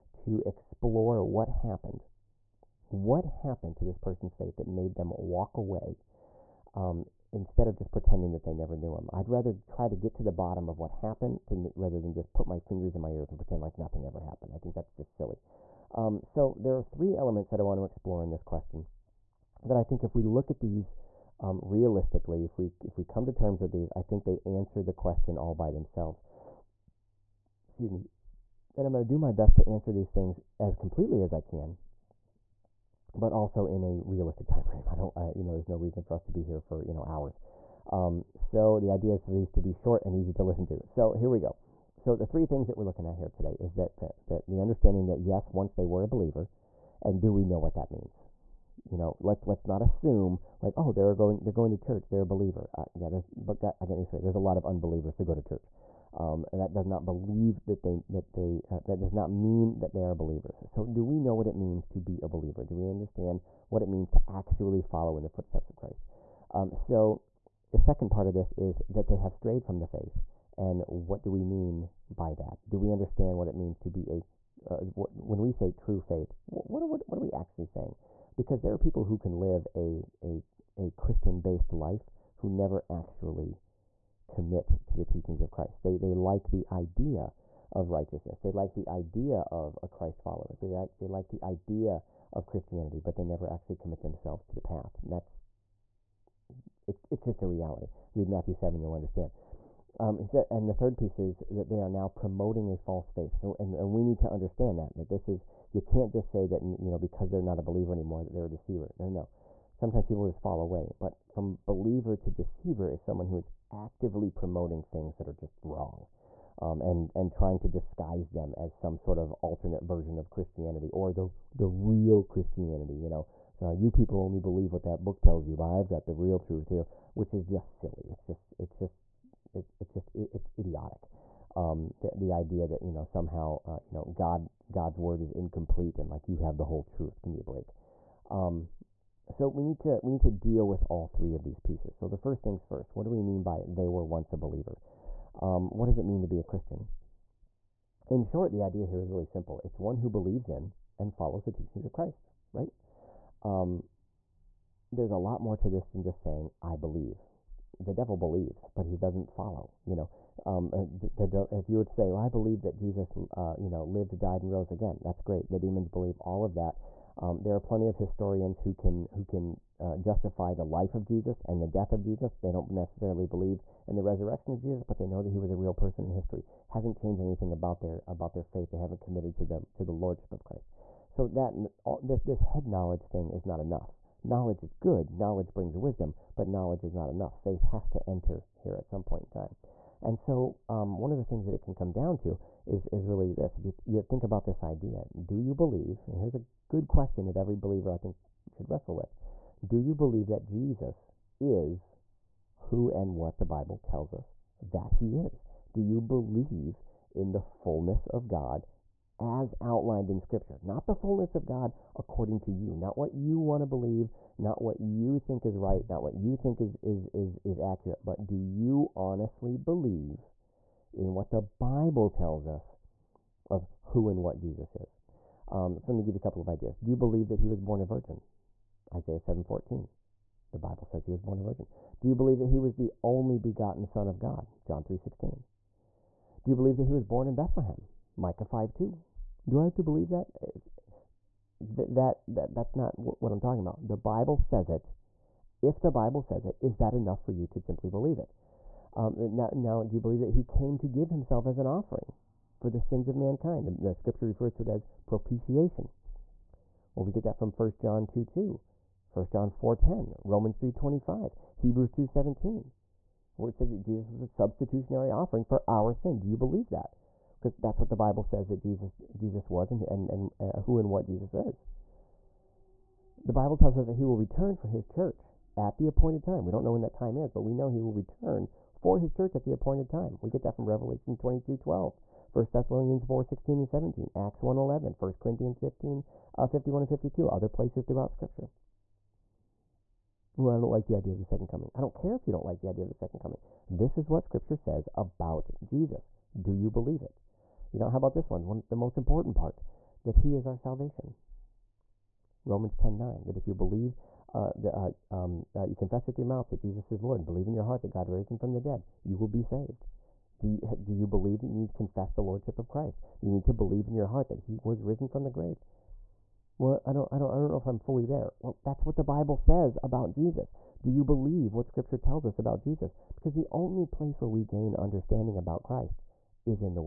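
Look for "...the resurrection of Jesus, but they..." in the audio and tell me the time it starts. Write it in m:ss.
2:53.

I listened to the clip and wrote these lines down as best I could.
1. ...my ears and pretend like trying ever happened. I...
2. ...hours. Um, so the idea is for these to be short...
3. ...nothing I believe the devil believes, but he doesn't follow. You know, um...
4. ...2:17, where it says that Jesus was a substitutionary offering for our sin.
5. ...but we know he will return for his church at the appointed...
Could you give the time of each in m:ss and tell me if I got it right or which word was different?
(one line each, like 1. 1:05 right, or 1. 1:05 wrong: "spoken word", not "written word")
1. 0:13 wrong: "nothing", not "trying"
2. 0:37 right
3. 2:36 wrong: "saying", not "nothing"
4. 4:21 right
5. 4:37 right.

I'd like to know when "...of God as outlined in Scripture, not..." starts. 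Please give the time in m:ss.
3:28.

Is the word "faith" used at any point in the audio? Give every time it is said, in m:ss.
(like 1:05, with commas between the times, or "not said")
0:04, 1:09, 1:16, 1:43, 2:58, 3:07.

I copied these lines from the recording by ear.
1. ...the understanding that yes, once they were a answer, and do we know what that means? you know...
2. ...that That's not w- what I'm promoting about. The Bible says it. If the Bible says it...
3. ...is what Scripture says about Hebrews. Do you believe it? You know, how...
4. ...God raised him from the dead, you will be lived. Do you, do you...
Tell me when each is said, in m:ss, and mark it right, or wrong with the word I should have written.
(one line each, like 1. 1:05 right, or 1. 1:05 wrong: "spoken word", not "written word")
1. 0:44 wrong: "believer", not "answer"
2. 4:02 wrong: "talking", not "promoting"
3. 4:53 wrong: "Jesus", not "Hebrews"
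4. 5:07 wrong: "saved", not "lived".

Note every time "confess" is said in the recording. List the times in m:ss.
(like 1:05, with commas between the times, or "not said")
5:05, 5:11.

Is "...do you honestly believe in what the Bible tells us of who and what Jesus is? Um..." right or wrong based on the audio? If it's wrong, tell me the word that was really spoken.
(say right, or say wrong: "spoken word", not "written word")
right.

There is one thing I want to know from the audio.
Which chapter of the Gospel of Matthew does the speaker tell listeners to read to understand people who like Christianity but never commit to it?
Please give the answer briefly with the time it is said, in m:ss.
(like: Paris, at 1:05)
Matthew 7, at 1:38.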